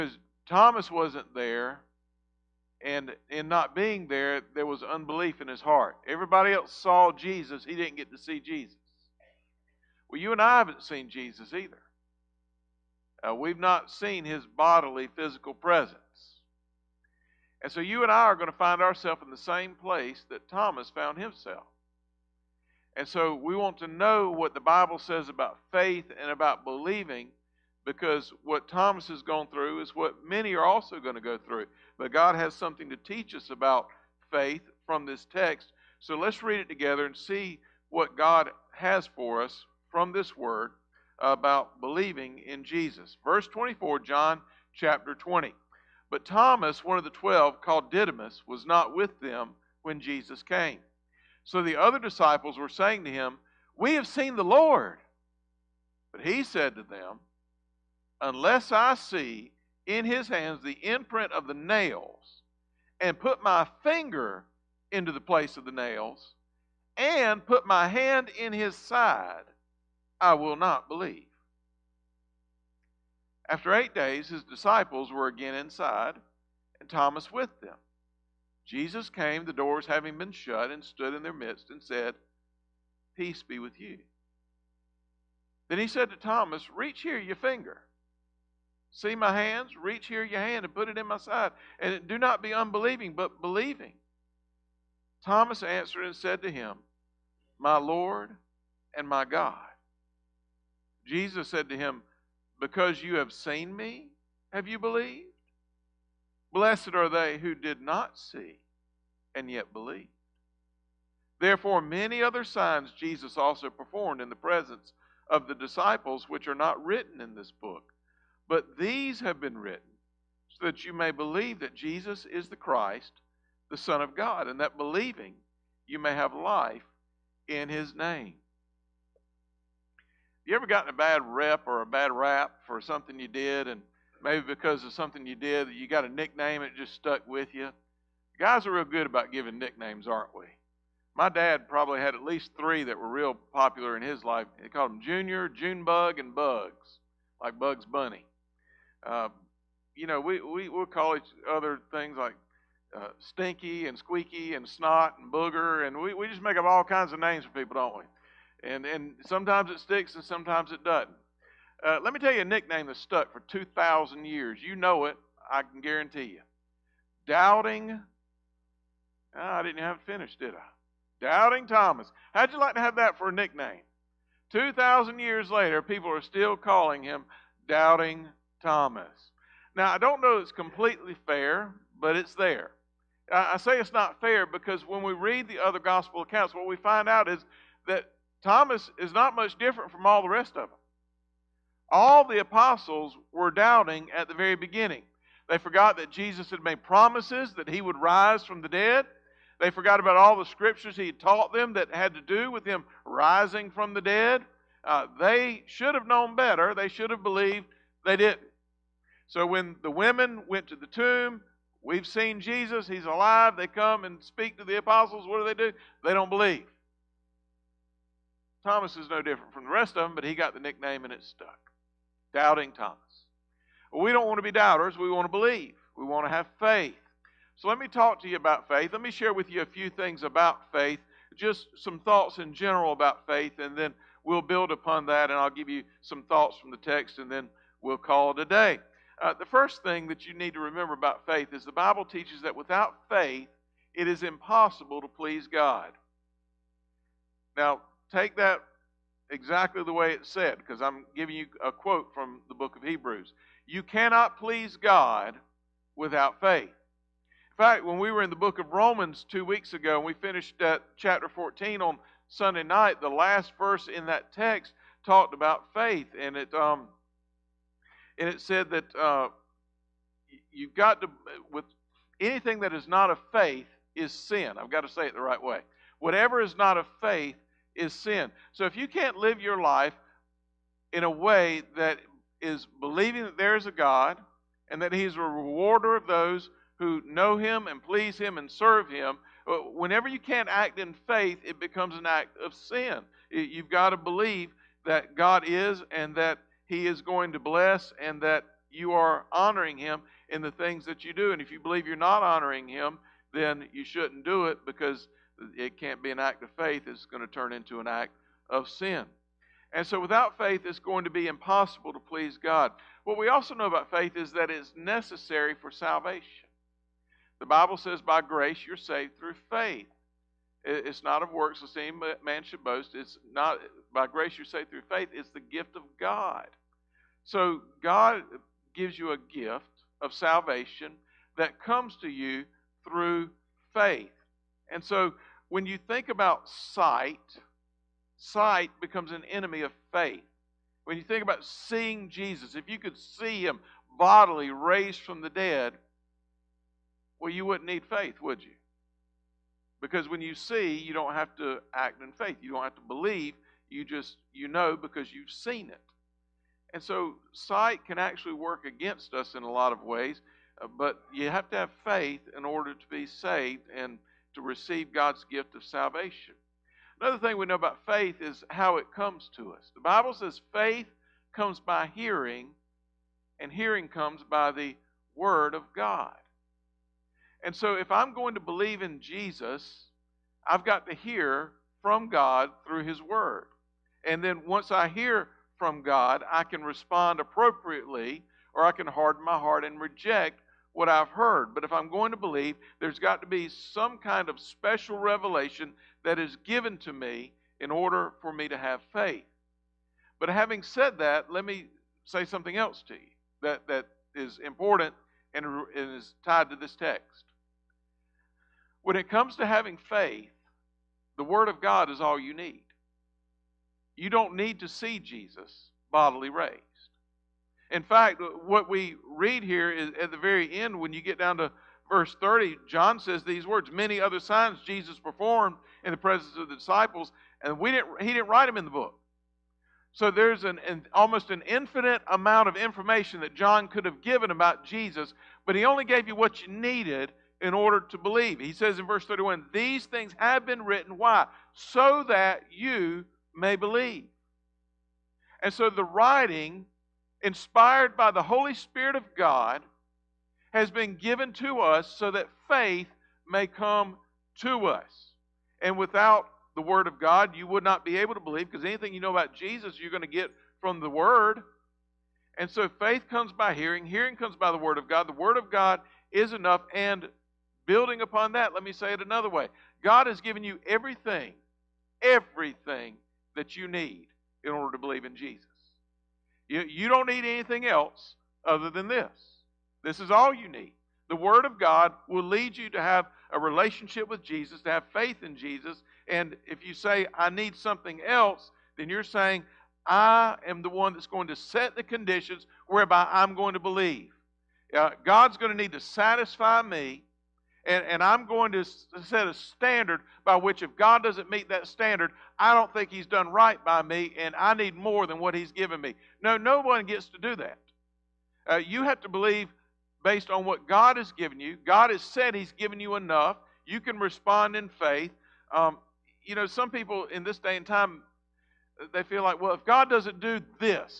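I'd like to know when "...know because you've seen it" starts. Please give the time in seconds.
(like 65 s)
354 s.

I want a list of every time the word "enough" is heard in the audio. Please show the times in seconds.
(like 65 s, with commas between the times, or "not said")
466 s, 512 s.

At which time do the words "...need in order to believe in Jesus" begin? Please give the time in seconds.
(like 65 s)
473 s.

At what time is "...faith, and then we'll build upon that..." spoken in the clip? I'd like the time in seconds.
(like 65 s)
233 s.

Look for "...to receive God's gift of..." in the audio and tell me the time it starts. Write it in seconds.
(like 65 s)
364 s.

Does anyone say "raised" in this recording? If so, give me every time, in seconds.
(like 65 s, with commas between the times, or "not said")
344 s, 416 s.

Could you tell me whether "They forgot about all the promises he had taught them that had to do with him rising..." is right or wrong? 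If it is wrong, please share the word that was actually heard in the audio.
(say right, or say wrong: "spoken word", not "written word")
wrong: "scriptures", not "promises".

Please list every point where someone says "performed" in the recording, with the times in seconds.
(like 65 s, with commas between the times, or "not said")
113 s, 424 s.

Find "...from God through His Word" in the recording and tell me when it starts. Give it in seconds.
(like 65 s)
381 s.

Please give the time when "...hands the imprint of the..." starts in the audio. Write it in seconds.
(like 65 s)
60 s.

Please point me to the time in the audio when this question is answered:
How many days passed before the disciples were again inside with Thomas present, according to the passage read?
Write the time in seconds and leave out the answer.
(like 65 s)
73 s.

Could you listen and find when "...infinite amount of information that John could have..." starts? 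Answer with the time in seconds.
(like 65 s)
431 s.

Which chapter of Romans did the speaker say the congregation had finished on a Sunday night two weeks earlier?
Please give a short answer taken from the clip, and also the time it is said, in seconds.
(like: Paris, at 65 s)
14, at 260 s.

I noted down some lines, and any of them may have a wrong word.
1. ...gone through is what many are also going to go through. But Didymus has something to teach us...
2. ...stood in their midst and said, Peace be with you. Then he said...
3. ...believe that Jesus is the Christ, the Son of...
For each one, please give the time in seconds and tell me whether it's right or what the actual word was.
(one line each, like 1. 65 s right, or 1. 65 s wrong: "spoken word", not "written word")
1. 29 s wrong: "God", not "Didymus"
2. 80 s right
3. 121 s right.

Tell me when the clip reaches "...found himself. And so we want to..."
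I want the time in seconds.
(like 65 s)
20 s.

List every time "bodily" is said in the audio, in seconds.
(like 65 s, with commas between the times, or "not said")
14 s, 343 s, 415 s.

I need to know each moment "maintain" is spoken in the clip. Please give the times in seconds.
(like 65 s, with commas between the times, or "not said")
not said.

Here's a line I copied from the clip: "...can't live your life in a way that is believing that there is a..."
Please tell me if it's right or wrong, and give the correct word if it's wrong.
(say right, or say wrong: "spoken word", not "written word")
right.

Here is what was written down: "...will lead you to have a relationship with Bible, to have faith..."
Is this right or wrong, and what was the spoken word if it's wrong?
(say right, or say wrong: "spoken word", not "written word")
wrong: "Jesus", not "Bible".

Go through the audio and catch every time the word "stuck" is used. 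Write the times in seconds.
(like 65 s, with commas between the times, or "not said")
136 s, 162 s, 221 s.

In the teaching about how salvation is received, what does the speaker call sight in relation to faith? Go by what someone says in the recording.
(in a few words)
an enemy.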